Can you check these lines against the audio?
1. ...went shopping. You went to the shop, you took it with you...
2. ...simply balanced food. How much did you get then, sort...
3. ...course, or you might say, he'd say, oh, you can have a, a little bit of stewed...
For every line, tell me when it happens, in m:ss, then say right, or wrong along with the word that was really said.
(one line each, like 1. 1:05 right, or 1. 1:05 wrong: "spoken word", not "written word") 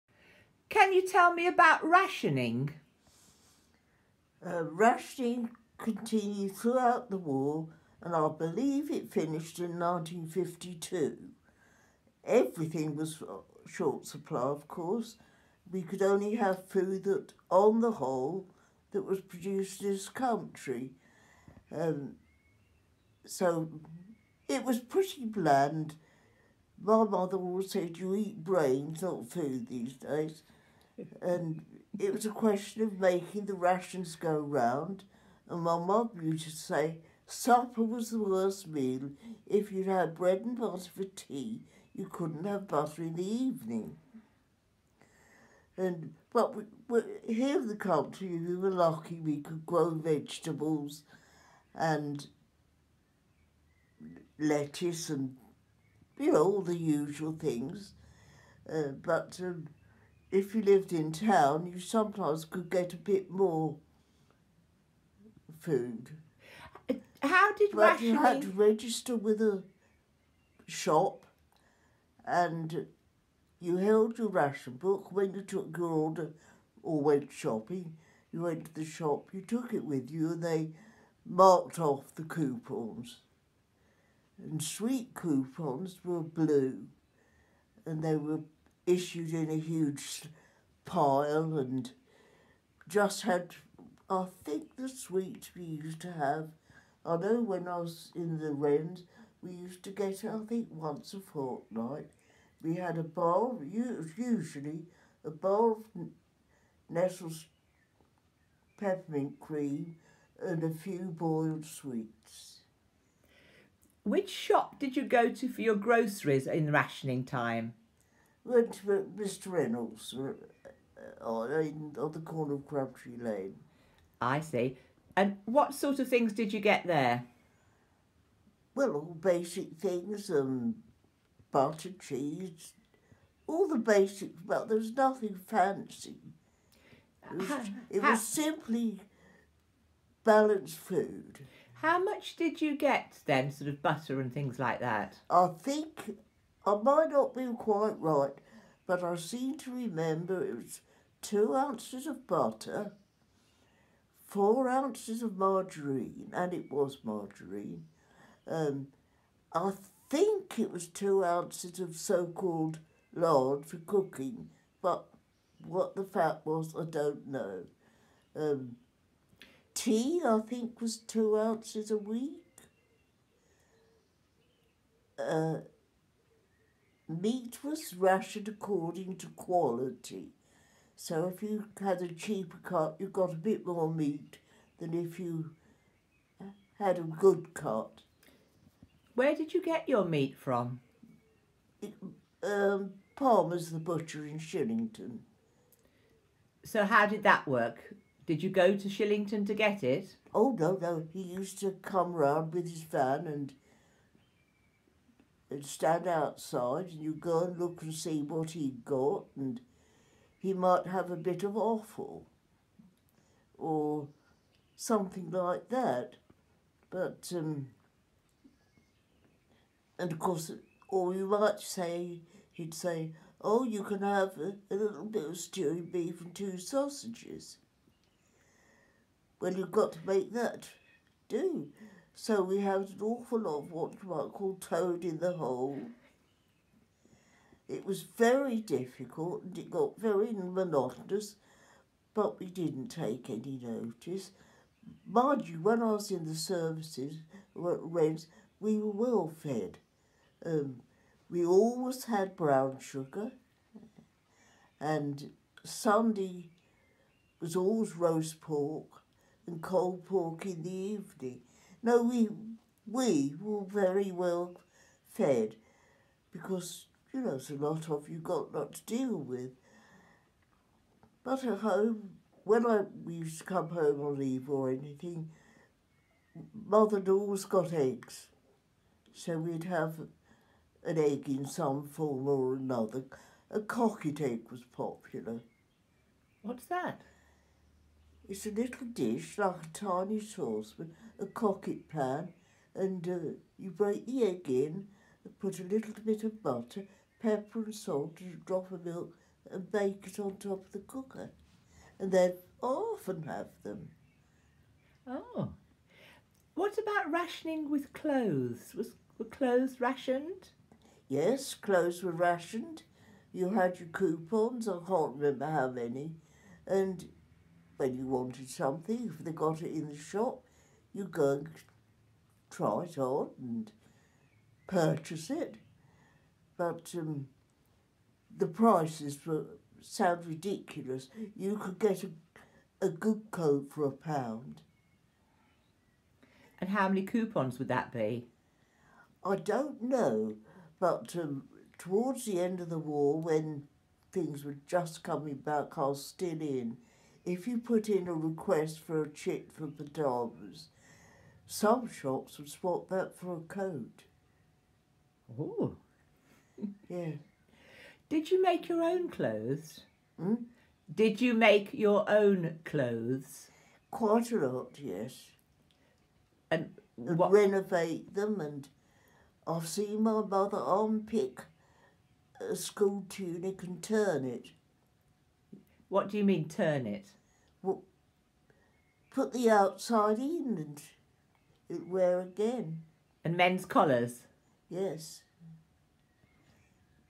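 1. 1:17 right
2. 2:18 right
3. 3:40 right.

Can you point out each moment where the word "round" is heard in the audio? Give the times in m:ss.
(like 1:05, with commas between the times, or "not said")
0:34, 3:22.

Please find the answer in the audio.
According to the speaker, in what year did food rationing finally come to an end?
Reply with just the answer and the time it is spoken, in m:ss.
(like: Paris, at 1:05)
1952, at 0:09.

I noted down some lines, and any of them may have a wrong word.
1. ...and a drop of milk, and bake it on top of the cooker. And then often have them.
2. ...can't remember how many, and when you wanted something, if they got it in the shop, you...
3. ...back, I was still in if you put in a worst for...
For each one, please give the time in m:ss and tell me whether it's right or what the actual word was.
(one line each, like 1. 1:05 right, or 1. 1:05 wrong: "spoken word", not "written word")
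1. 4:58 right
2. 5:14 right
3. 5:45 wrong: "request", not "worst".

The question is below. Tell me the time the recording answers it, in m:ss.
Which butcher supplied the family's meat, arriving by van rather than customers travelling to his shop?
3:13.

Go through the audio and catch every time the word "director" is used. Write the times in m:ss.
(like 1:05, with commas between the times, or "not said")
not said.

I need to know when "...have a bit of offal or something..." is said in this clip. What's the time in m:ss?
3:30.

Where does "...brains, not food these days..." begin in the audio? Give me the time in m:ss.
0:28.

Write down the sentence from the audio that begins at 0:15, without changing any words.
We could only have food that, on the whole, that was produced in this country.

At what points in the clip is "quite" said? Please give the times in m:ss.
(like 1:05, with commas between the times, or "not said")
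2:27, 6:03.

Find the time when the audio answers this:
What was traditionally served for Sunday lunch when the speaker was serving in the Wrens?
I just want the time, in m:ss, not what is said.
4:17.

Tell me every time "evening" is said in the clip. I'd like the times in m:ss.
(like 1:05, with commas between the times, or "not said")
0:43, 4:20.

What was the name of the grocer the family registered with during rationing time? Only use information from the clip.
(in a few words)
Mr. Reynolds.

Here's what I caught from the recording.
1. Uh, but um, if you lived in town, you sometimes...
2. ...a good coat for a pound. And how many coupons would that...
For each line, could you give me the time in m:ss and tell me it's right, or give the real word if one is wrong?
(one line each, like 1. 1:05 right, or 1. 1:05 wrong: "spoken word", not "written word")
1. 0:58 right
2. 5:32 right.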